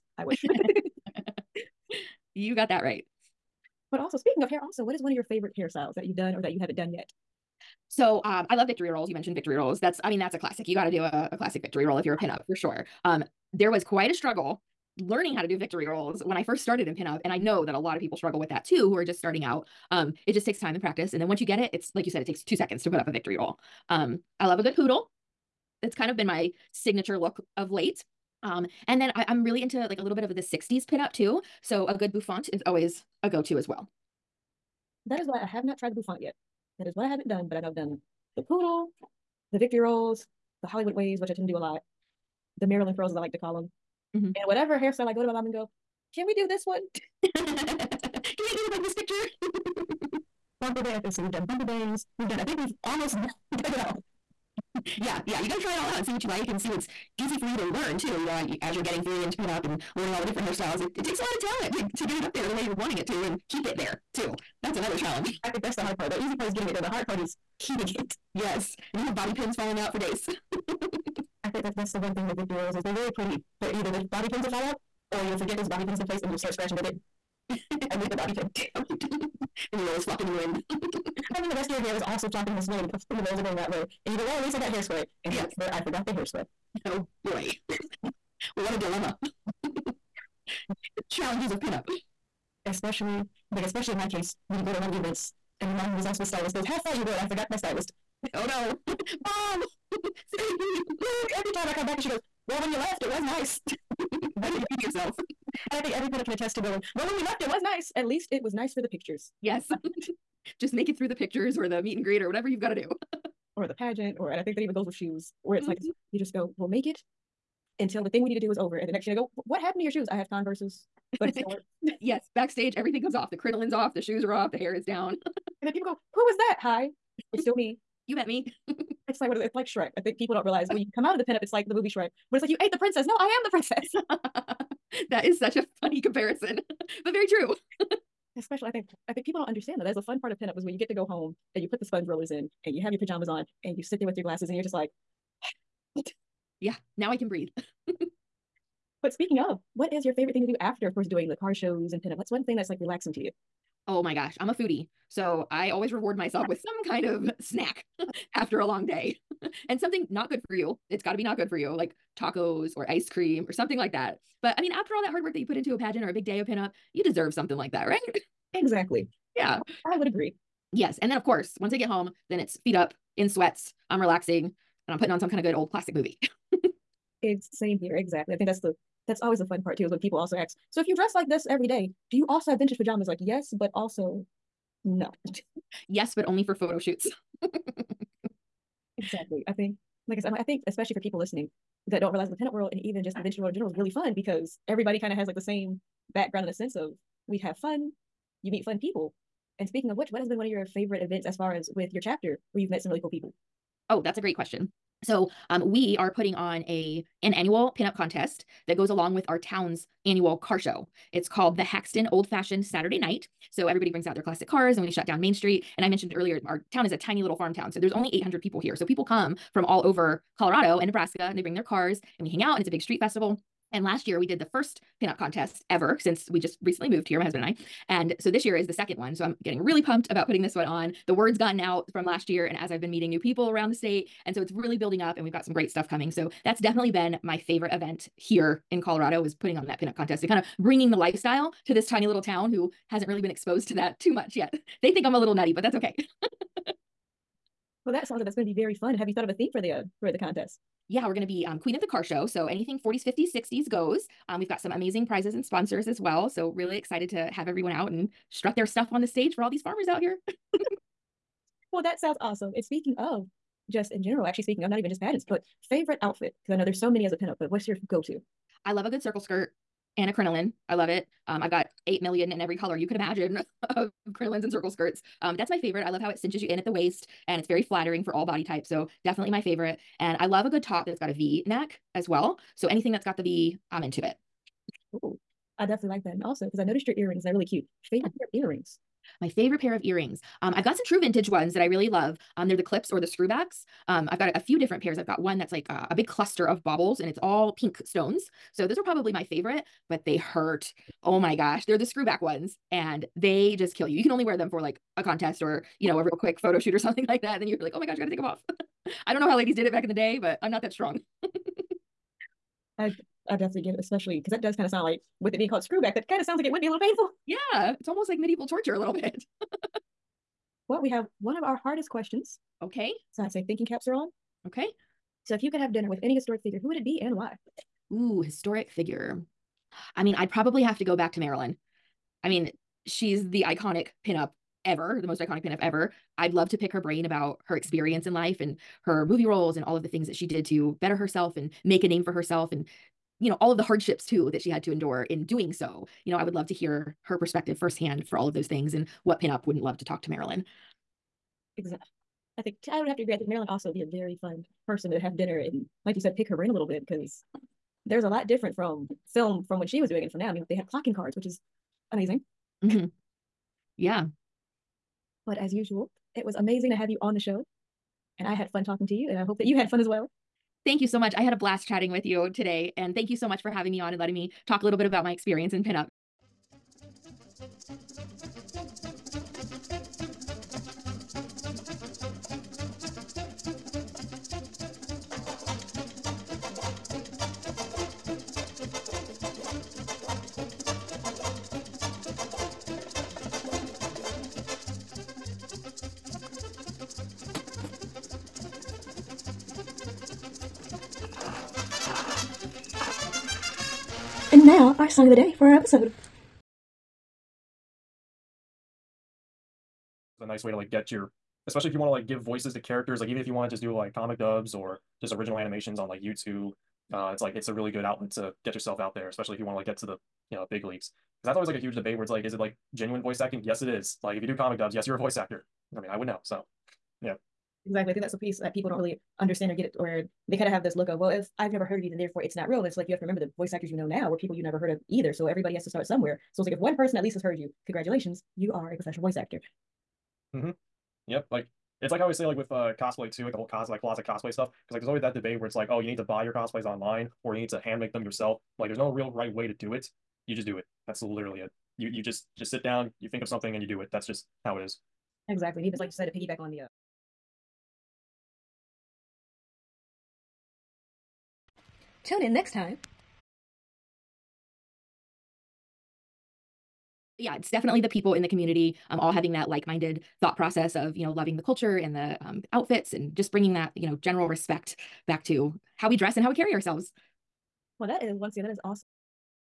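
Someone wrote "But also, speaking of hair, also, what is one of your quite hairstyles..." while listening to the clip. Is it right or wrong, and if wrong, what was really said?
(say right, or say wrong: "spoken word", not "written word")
wrong: "favorite", not "quite".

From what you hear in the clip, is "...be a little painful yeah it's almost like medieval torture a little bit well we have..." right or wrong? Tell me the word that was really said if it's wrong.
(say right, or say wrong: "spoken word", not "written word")
right.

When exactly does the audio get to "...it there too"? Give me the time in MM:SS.
01:03.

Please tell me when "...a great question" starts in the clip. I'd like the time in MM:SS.
03:24.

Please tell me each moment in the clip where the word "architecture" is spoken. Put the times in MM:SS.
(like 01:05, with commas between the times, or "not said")
not said.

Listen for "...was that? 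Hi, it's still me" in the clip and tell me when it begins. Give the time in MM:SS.
02:06.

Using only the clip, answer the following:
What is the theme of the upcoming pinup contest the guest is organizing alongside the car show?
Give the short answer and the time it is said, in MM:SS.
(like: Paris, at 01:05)
Queen of the Car Show, at 04:11.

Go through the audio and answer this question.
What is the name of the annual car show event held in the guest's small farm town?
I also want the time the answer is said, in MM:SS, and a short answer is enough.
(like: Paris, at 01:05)
Haxtun Old Fashioned Saturday Night, at 03:31.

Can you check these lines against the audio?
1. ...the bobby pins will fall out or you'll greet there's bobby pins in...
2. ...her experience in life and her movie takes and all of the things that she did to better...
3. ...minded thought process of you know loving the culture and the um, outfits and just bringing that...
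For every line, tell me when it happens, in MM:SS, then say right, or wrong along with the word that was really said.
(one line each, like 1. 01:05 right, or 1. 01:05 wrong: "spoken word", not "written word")
1. 01:13 wrong: "forget", not "greet"
2. 05:37 wrong: "roles", not "takes"
3. 07:49 right.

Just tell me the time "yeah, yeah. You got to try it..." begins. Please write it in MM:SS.
00:55.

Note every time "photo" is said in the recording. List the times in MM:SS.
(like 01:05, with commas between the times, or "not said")
03:06, 05:06.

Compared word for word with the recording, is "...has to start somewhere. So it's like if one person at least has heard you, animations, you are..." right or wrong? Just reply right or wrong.
wrong.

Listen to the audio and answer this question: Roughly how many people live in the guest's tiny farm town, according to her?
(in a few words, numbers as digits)
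800.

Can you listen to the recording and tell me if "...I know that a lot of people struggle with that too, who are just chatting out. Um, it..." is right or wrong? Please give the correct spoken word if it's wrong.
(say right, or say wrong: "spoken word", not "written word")
wrong: "starting", not "chatting".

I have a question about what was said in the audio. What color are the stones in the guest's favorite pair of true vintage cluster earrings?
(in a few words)
pink.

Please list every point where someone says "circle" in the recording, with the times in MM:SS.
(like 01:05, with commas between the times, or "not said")
04:29, 04:34.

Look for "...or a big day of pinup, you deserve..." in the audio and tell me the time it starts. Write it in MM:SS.
02:46.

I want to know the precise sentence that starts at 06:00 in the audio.
I mean, they had clocking cards, which is amazing.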